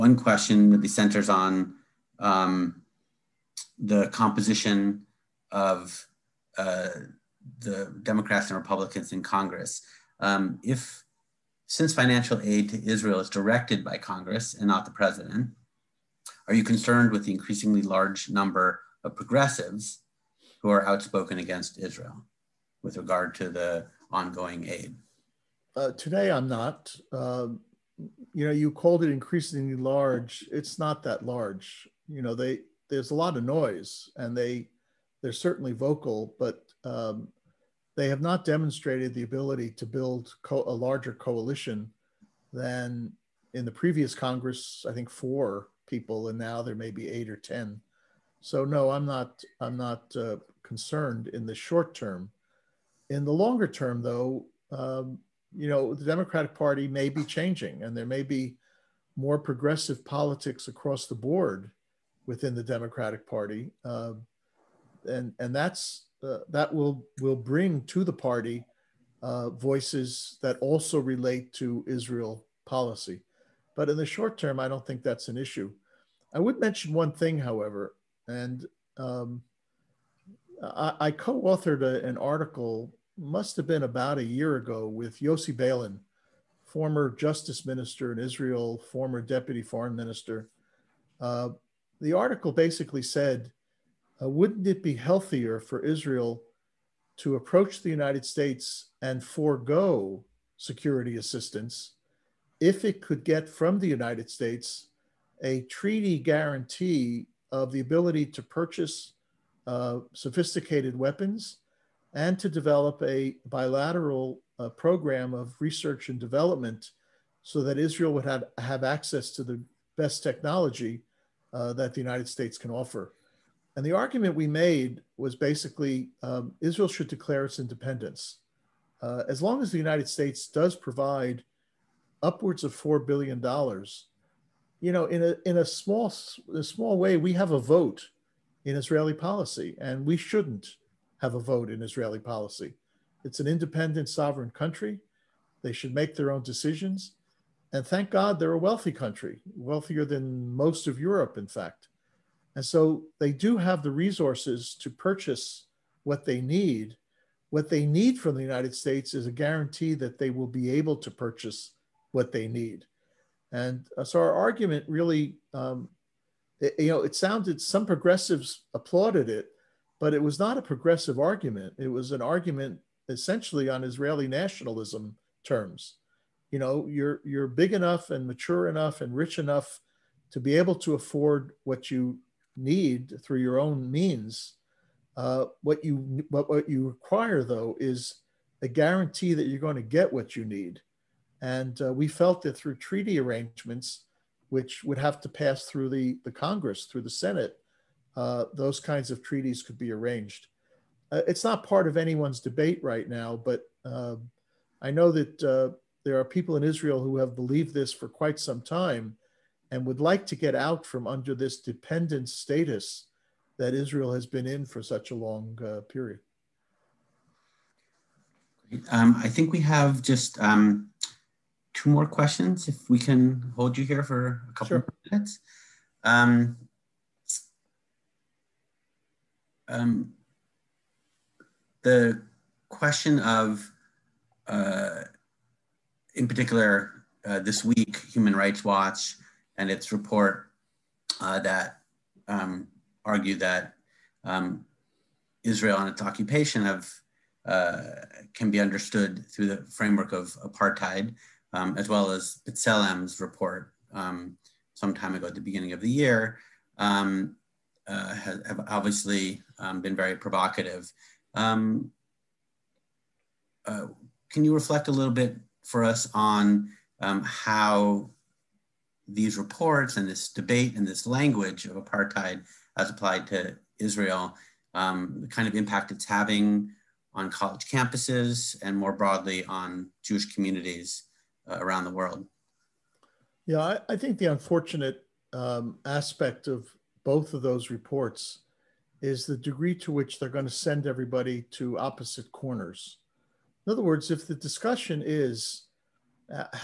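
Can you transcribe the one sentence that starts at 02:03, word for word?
And the argument we made was basically um, Israel should declare its independence.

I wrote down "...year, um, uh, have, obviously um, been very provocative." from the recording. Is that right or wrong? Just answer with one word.
right.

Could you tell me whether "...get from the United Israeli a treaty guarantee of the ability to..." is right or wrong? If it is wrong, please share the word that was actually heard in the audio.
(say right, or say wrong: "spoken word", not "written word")
wrong: "States", not "Israeli".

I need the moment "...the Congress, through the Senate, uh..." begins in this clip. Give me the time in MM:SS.
03:16.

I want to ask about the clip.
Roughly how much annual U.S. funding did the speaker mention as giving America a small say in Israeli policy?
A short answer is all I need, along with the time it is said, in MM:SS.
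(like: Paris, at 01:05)
$4 billion, at 02:12.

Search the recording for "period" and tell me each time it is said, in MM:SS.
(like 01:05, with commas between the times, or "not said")
03:35.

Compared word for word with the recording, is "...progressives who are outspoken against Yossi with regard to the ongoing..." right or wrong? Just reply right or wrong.
wrong.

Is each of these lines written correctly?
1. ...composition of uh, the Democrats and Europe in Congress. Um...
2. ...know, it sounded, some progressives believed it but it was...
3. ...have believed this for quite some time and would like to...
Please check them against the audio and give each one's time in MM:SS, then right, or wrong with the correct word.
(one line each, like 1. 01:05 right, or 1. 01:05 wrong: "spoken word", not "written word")
1. 00:04 wrong: "Republicans", not "Europe"
2. 02:46 wrong: "applauded", not "believed"
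3. 03:27 right.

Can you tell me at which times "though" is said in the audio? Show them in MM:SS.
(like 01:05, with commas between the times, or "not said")
00:54, 03:07.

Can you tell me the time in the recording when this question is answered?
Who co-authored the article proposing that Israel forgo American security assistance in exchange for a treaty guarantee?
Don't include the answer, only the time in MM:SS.
01:25.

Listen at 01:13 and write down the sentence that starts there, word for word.
But in the short term, I don't think that's an issue.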